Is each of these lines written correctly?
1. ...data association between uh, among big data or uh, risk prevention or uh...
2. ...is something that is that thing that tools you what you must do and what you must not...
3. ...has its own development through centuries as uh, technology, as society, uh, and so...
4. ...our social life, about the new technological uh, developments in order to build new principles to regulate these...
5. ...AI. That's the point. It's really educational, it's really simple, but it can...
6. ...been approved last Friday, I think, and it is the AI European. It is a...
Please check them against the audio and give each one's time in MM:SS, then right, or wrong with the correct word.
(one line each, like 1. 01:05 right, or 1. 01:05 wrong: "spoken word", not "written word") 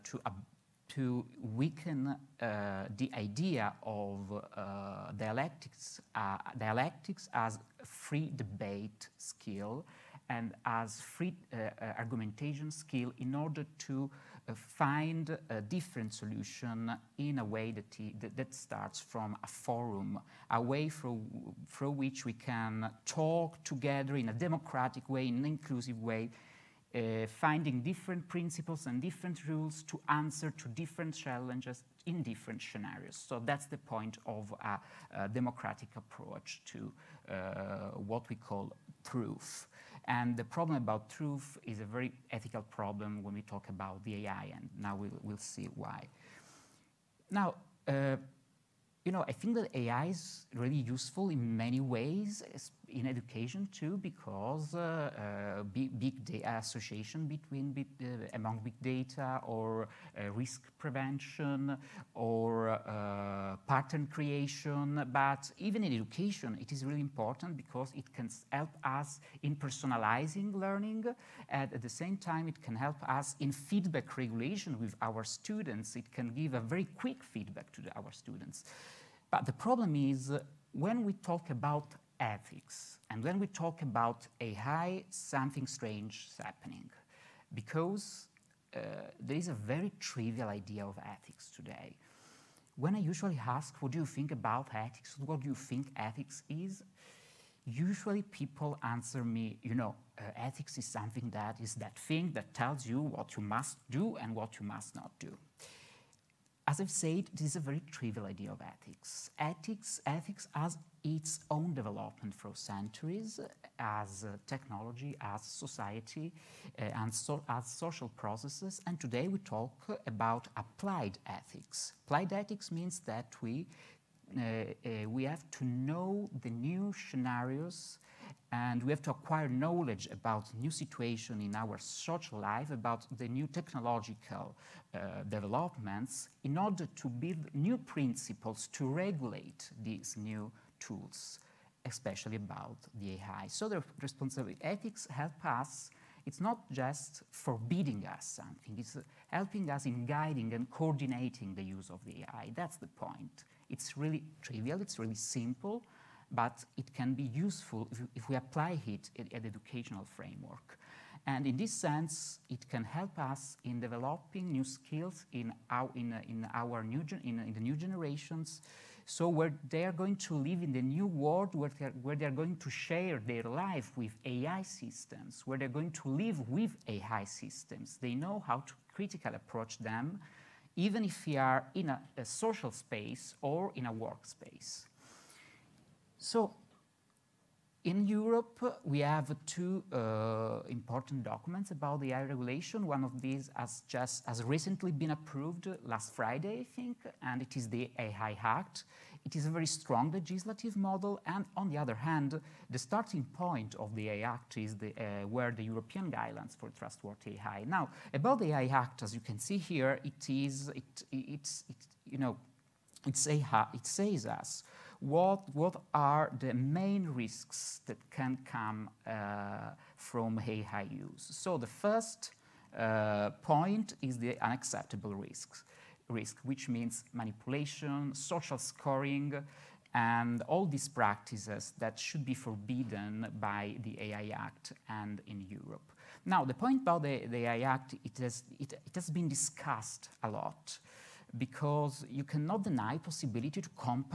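1. 00:56 right
2. 01:40 wrong: "tells", not "tools"
3. 01:50 right
4. 02:11 right
5. 02:32 wrong: "trivial", not "educational"
6. 03:14 wrong: "Act", not "European".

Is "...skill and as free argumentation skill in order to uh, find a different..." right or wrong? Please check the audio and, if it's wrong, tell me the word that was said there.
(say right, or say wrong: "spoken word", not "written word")
right.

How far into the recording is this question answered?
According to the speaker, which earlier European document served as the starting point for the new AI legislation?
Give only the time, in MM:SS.
03:25.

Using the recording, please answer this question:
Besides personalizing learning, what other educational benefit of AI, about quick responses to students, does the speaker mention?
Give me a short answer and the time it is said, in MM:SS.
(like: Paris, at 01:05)
feedback regulation, at 01:13.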